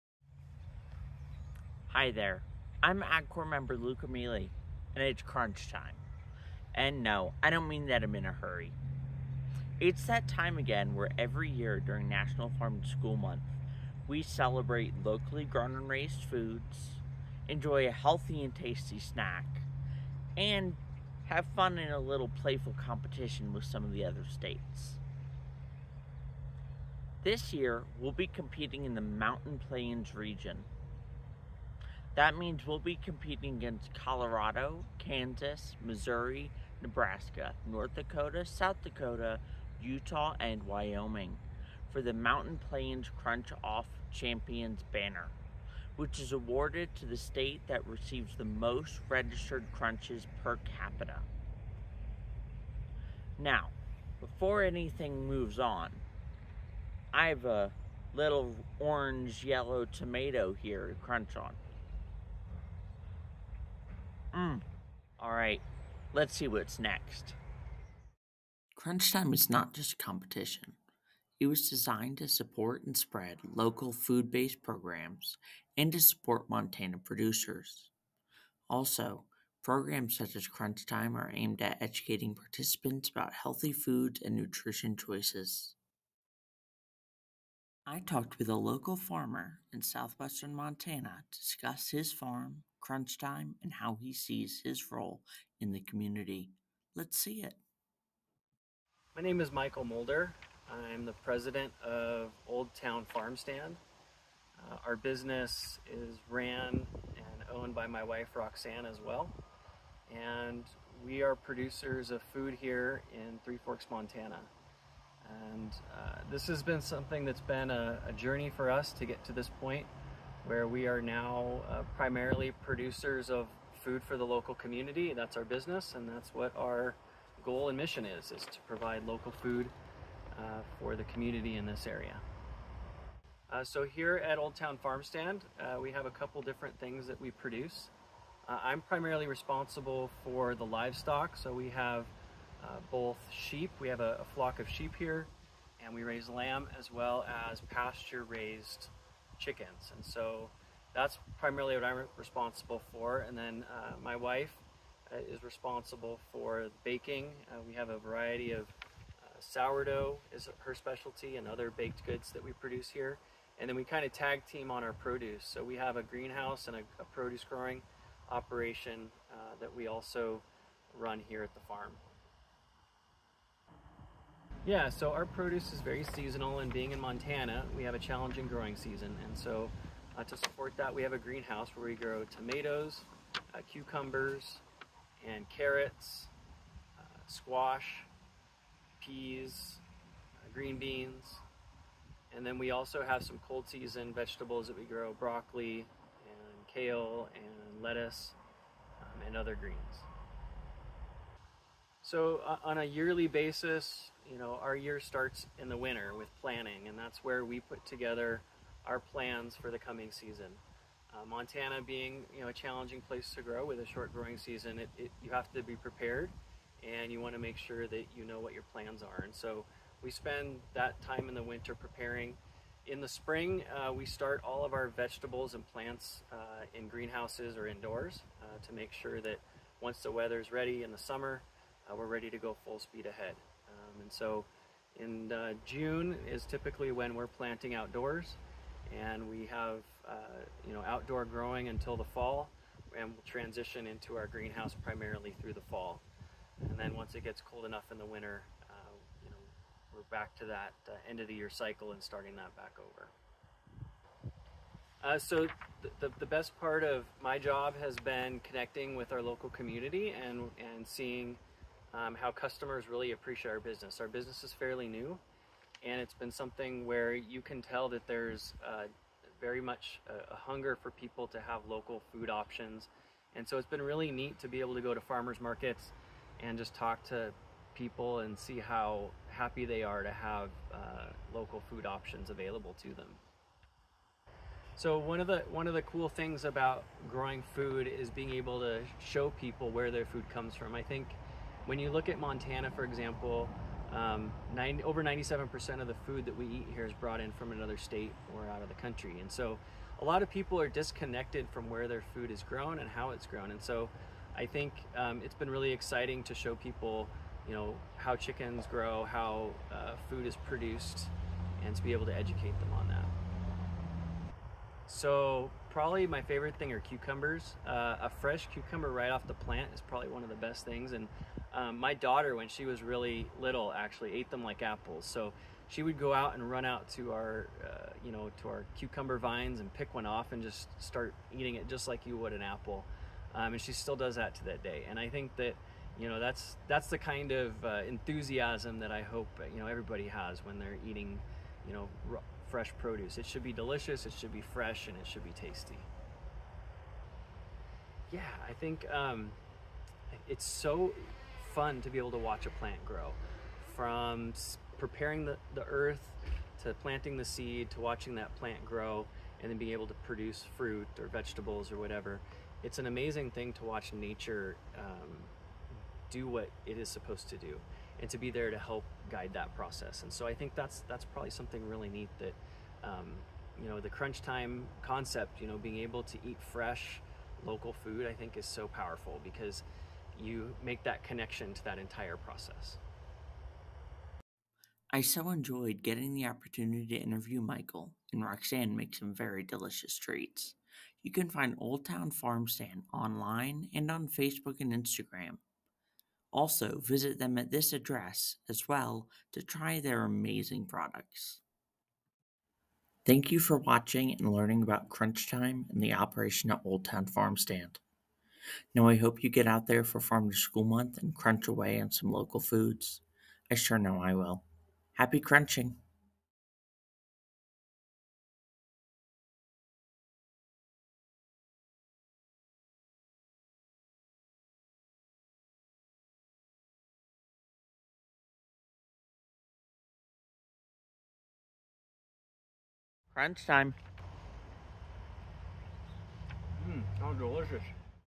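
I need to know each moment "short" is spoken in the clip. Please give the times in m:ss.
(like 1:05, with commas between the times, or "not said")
3:33.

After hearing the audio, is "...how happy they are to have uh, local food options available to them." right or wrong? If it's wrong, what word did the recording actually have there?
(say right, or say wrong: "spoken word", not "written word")
right.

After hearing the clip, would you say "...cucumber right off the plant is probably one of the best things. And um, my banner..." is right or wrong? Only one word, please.
wrong.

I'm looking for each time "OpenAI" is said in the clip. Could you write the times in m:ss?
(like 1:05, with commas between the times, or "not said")
not said.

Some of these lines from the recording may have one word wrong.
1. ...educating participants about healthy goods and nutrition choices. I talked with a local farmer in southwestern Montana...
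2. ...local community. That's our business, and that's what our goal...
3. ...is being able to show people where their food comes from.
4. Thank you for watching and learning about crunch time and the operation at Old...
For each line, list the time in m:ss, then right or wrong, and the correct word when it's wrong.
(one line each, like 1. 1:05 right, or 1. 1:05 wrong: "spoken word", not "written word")
1. 1:21 wrong: "foods", not "goods"
2. 2:04 right
3. 4:47 right
4. 6:43 right.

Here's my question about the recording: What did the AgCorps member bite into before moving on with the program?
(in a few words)
orange yellow tomato.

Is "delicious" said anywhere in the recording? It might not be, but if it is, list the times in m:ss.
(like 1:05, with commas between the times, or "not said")
5:43, 6:29, 7:17.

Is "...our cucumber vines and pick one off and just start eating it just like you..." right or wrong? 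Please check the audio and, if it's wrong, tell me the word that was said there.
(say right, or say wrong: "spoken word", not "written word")
right.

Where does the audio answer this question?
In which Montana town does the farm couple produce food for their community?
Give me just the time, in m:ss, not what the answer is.
1:53.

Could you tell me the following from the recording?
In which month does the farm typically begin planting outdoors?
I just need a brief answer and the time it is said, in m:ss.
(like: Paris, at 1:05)
June, at 3:55.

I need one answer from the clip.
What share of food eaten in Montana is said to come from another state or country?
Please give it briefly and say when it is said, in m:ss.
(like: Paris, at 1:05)
over 97%, at 4:54.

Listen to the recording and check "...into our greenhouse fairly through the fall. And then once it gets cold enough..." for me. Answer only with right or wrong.
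wrong.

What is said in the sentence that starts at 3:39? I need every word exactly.
And so we spend that time in the winter preparing.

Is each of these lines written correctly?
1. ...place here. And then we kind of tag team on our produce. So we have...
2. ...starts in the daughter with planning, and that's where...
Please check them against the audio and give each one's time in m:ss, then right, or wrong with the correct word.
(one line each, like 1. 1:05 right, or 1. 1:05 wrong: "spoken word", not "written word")
1. 2:42 wrong: "produce", not "place"
2. 3:24 wrong: "winter", not "daughter".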